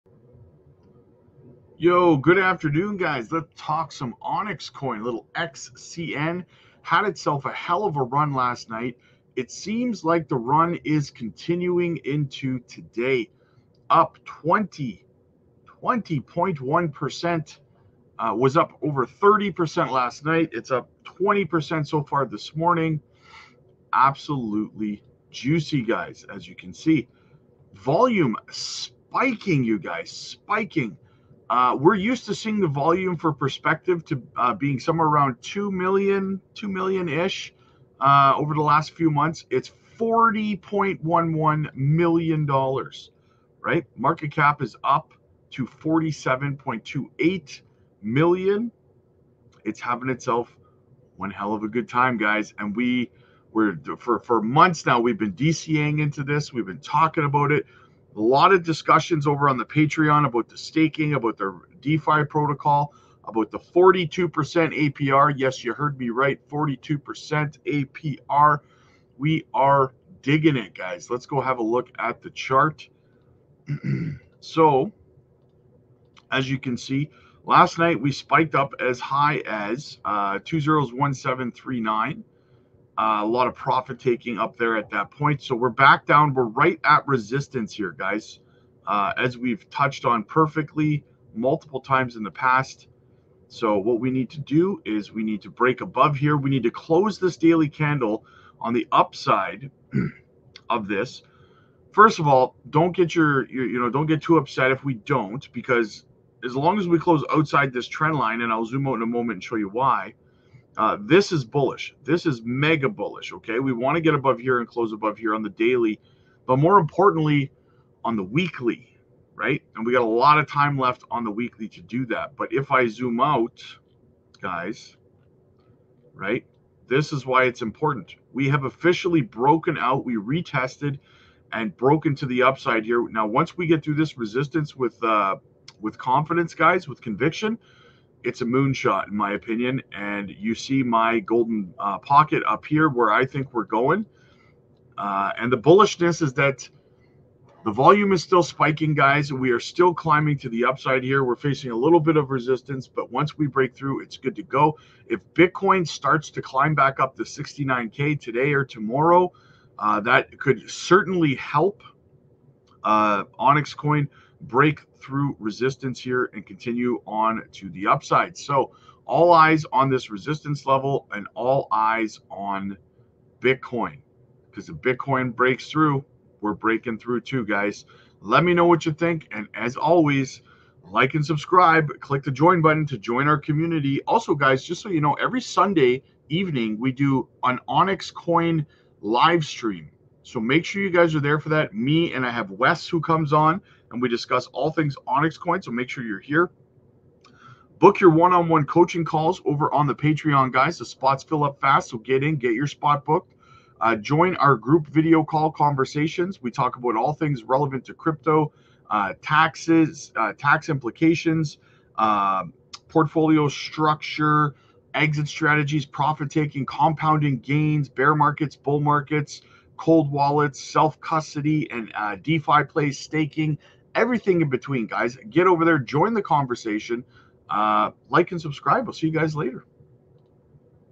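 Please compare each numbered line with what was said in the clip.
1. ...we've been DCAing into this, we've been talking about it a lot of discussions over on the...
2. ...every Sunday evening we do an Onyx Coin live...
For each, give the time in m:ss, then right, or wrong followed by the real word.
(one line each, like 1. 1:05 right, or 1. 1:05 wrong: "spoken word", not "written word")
1. 0:55 right
2. 3:05 right.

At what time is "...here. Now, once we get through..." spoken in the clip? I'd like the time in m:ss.
2:12.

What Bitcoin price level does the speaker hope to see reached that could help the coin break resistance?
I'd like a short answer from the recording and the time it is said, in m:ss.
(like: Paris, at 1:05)
69K, at 2:37.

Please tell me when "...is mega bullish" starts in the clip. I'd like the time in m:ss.
1:52.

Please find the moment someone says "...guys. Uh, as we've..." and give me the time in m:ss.
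1:27.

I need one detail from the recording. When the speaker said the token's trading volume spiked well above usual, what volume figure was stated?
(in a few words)
$40.11 million.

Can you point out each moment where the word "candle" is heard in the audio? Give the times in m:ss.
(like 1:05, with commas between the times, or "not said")
1:37.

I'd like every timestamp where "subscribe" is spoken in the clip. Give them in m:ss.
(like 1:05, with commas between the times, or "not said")
3:01, 3:48.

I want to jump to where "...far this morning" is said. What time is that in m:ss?
0:22.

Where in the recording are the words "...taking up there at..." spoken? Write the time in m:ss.
1:23.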